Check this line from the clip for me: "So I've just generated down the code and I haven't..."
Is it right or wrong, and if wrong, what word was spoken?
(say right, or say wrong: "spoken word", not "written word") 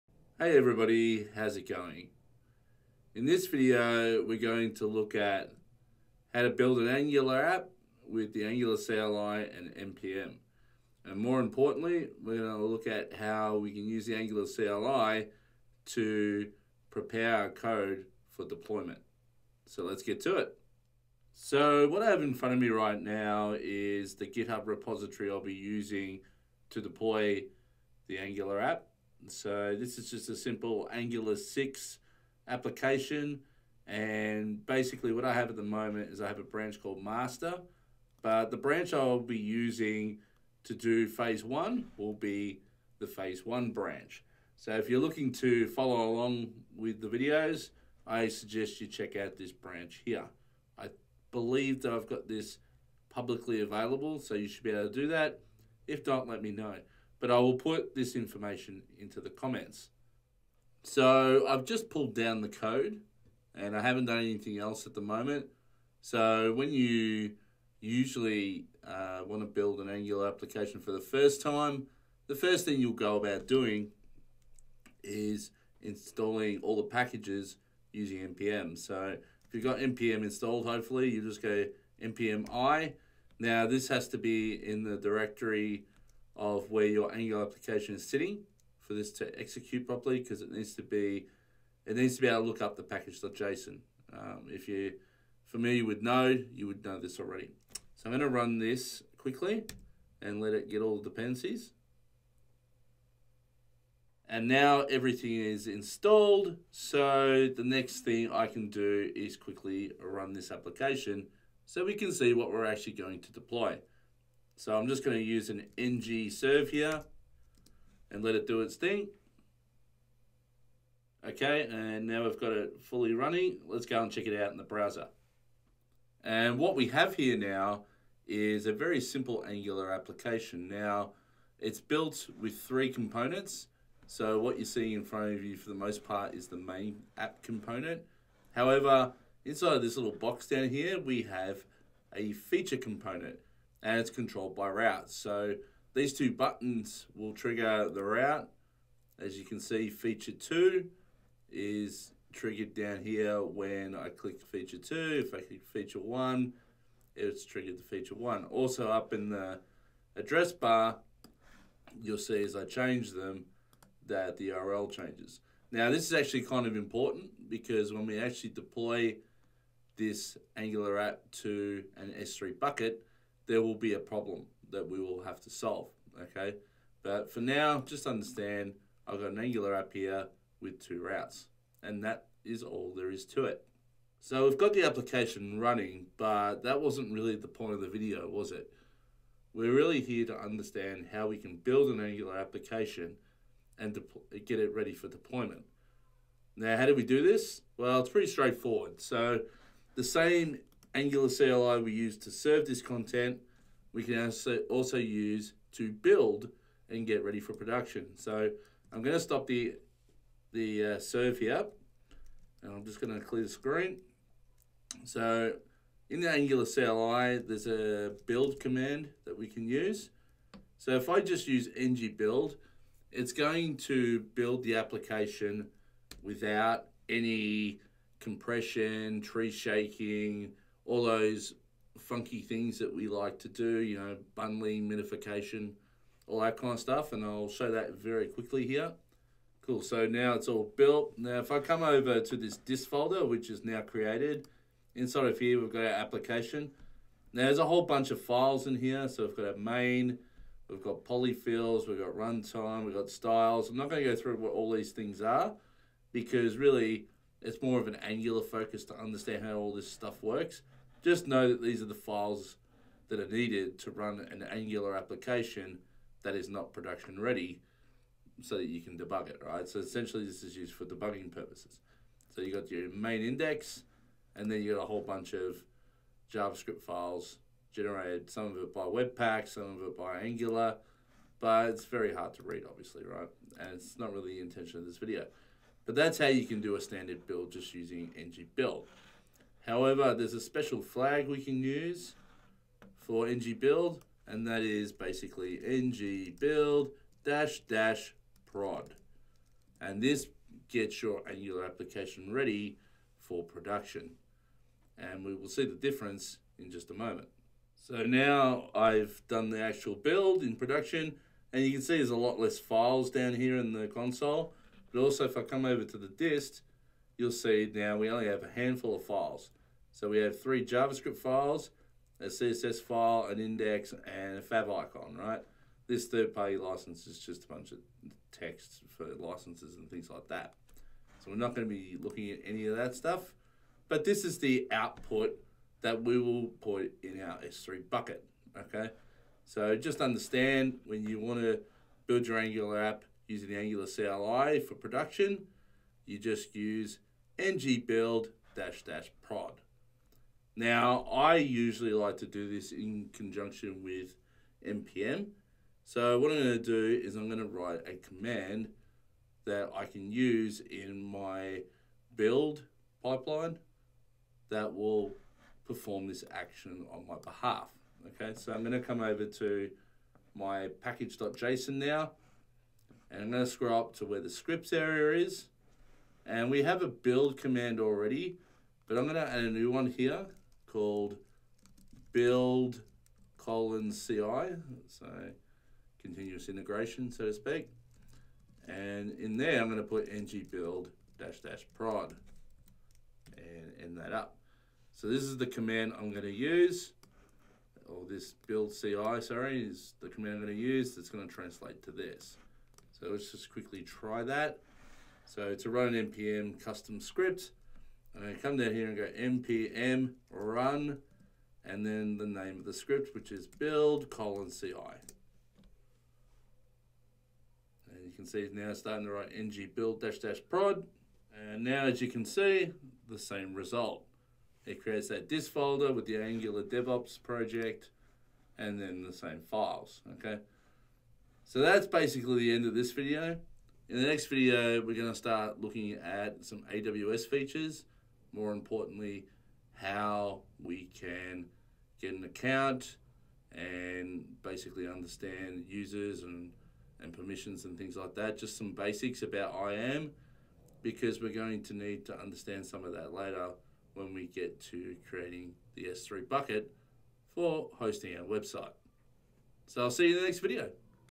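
wrong: "pulled", not "generated".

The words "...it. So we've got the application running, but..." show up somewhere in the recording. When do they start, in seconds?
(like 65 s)
183 s.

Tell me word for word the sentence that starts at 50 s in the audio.
I believe that I've got this publicly available, so you should be able to do that.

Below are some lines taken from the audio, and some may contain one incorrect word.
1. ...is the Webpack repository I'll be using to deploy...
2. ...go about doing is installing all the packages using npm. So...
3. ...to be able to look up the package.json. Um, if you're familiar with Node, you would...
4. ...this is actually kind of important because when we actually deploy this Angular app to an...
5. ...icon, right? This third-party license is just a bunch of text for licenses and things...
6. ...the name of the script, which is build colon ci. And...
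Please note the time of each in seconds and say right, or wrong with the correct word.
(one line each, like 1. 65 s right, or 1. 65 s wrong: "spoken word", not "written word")
1. 23 s wrong: "GitHub", not "Webpack"
2. 72 s right
3. 92 s right
4. 165 s right
5. 324 s right
6. 412 s right.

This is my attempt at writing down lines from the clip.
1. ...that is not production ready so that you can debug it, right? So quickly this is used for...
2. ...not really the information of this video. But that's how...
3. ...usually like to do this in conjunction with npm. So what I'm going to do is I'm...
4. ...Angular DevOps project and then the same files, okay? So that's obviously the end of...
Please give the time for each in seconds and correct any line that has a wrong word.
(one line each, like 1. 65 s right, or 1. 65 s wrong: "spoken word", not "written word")
1. 266 s wrong: "essentially", not "quickly"
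2. 283 s wrong: "intention", not "information"
3. 351 s right
4. 426 s wrong: "basically", not "obviously".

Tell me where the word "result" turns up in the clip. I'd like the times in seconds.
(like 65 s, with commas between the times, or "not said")
423 s.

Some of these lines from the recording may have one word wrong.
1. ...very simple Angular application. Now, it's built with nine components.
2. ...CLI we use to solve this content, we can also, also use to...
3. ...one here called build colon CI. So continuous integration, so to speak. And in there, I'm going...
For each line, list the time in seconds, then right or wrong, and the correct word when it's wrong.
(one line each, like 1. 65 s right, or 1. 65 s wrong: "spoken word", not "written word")
1. 128 s wrong: "three", not "nine"
2. 201 s wrong: "serve", not "solve"
3. 379 s right.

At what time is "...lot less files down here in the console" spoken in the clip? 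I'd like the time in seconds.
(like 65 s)
312 s.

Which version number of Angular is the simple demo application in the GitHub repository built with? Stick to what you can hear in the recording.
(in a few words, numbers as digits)
6.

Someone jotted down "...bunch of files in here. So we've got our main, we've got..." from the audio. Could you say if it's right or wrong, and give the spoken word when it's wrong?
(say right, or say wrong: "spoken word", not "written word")
right.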